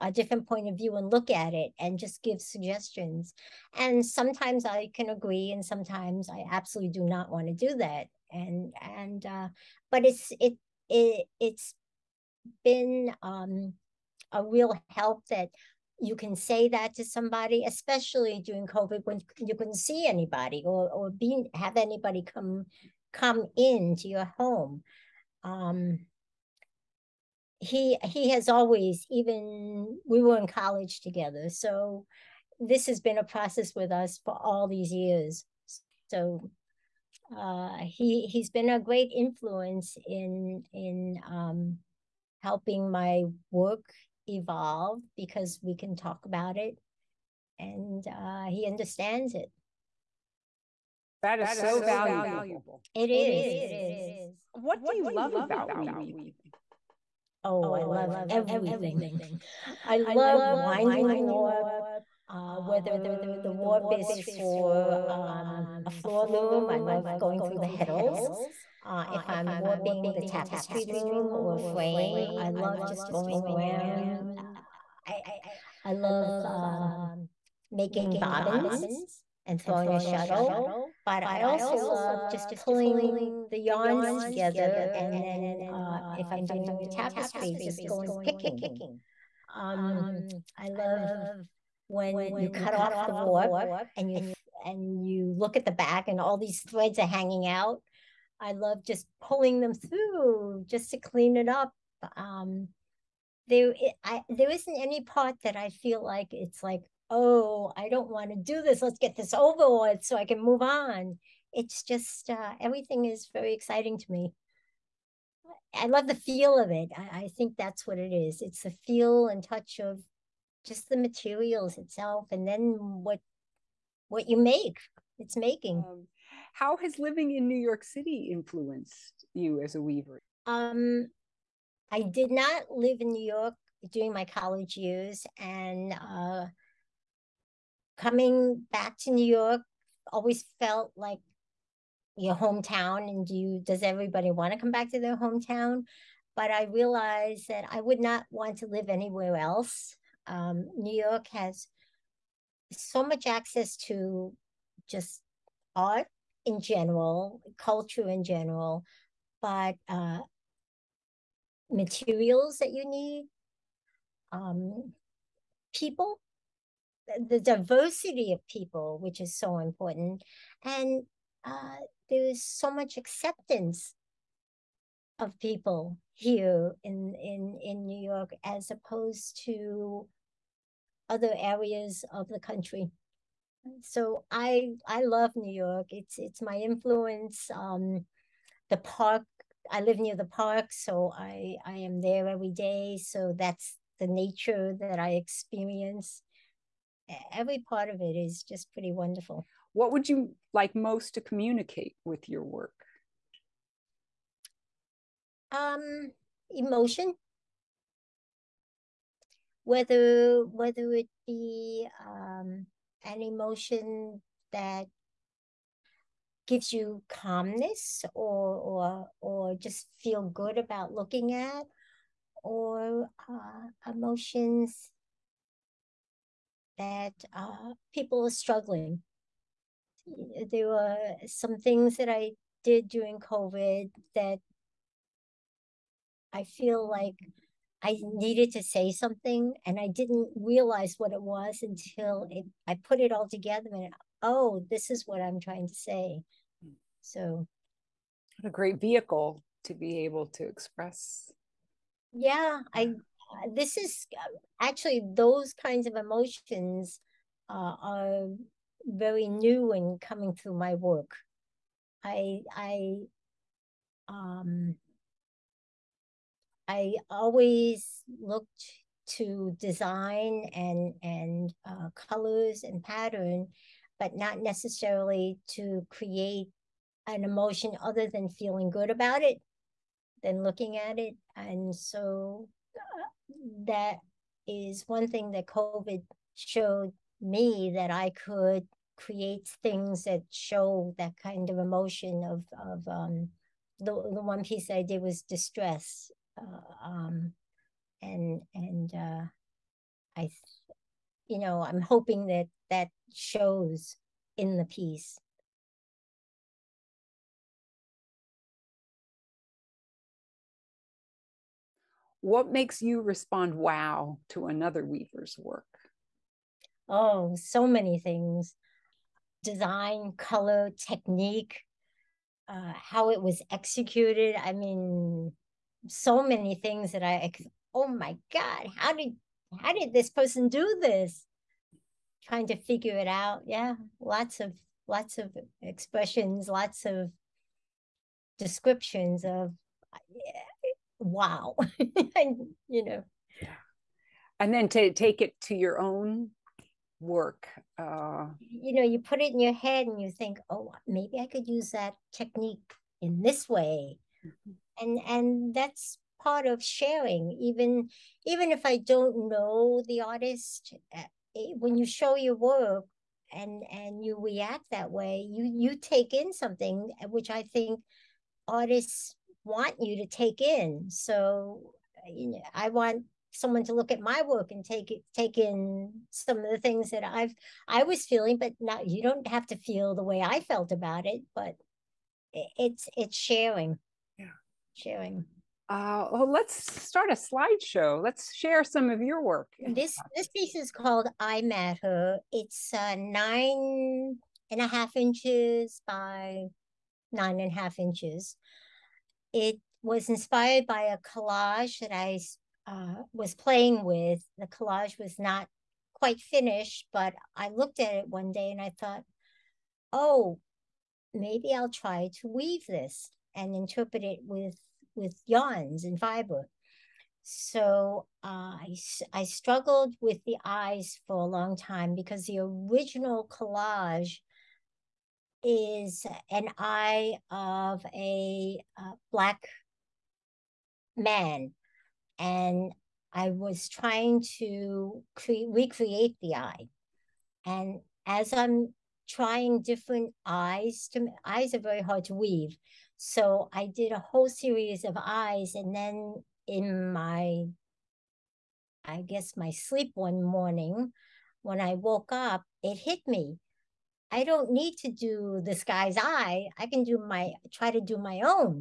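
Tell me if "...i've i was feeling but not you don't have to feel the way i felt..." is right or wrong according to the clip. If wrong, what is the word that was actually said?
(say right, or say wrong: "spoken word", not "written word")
right.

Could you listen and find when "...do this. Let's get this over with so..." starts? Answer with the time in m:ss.
1:48.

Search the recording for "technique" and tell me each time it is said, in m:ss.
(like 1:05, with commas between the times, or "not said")
5:20, 5:52.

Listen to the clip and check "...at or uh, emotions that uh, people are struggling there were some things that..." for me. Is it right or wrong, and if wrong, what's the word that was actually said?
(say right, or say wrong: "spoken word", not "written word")
right.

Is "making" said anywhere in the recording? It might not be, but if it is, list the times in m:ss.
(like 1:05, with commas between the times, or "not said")
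1:17, 2:05.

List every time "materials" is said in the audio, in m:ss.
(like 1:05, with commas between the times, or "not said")
2:00, 2:41.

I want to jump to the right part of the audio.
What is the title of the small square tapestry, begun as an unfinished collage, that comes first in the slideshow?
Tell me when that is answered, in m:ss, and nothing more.
6:31.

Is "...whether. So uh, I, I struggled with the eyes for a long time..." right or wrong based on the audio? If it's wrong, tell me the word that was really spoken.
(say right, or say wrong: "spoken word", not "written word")
wrong: "fiber", not "whether".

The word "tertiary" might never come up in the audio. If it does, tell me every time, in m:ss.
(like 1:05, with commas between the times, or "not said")
not said.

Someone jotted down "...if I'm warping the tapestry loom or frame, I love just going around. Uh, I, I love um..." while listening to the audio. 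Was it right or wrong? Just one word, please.
right.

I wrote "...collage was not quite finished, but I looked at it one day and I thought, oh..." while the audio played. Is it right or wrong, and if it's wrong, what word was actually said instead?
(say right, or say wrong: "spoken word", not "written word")
right.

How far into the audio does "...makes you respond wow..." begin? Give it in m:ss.
5:12.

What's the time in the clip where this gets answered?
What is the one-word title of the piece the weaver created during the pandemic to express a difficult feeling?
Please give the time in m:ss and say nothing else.
4:55.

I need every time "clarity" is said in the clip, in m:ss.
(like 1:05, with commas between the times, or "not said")
not said.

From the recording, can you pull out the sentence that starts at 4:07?
So, what a great vehicle to be able to express.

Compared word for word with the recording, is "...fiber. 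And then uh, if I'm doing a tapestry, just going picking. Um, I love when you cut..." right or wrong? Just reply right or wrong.
wrong.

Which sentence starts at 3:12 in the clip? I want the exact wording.
So that's the nature that I experience.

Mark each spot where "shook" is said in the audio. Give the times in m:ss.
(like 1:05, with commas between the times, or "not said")
not said.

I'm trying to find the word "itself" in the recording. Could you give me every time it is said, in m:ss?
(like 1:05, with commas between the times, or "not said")
2:01.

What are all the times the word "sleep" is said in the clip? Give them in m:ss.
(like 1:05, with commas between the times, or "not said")
7:29.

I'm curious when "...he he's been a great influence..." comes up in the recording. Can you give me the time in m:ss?
0:37.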